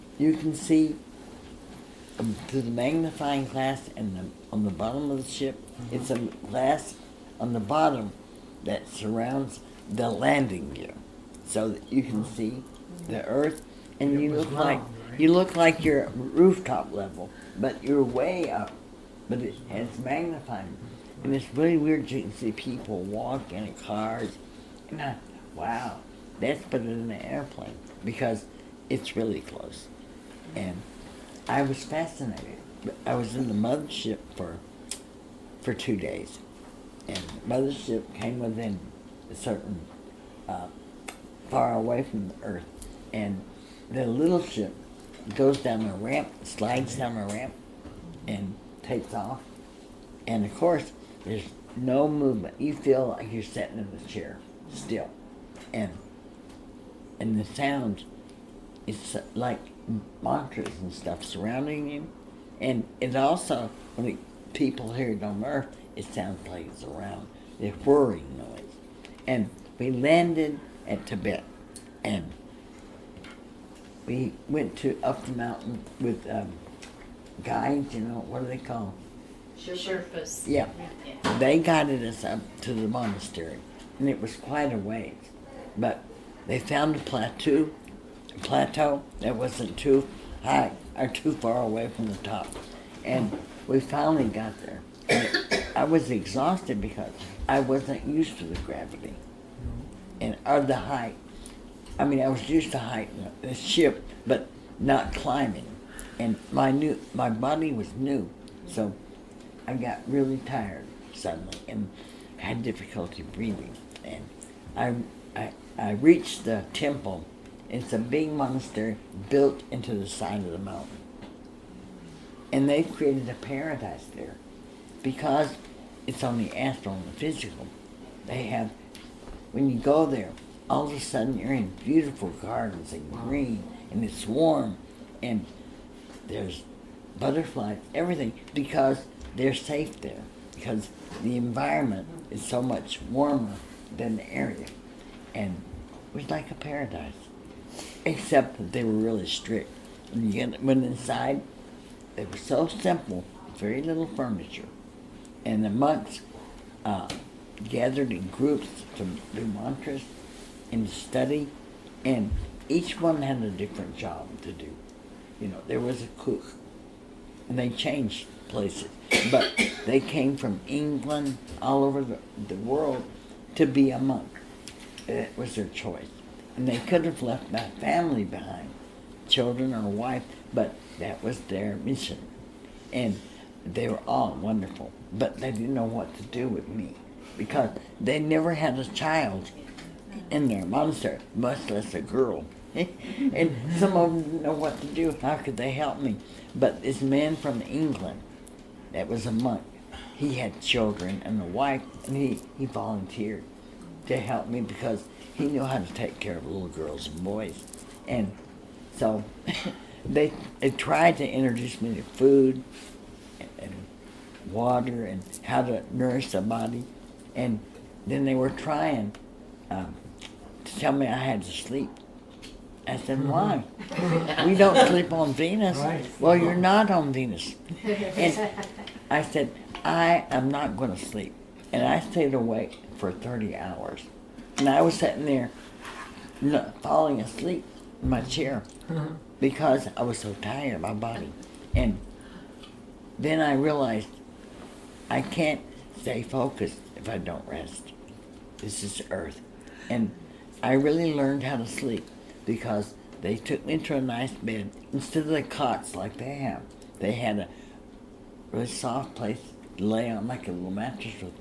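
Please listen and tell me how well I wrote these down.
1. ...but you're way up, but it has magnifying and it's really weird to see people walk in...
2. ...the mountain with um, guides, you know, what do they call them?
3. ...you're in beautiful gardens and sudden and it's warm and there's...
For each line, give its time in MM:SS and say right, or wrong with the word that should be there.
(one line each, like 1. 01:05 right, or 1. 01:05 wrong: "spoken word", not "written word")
1. 00:17 right
2. 01:15 right
3. 02:11 wrong: "green", not "sudden".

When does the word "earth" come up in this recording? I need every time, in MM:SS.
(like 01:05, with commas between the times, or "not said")
00:13, 00:42, 01:05, 04:09.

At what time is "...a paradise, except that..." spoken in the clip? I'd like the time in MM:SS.
02:26.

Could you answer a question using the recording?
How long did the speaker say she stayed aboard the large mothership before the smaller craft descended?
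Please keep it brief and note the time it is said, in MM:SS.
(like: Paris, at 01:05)
2 days, at 00:35.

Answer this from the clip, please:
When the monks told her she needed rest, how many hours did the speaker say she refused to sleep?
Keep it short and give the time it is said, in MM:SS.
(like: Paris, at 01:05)
30, at 03:53.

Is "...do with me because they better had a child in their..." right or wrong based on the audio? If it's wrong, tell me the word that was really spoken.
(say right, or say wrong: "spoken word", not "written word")
wrong: "never", not "better".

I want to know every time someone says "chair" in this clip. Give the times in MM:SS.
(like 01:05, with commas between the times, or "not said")
00:54, 03:58.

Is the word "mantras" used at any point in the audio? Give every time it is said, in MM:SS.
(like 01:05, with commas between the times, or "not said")
01:00, 02:39.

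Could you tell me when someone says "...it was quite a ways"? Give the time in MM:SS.
01:24.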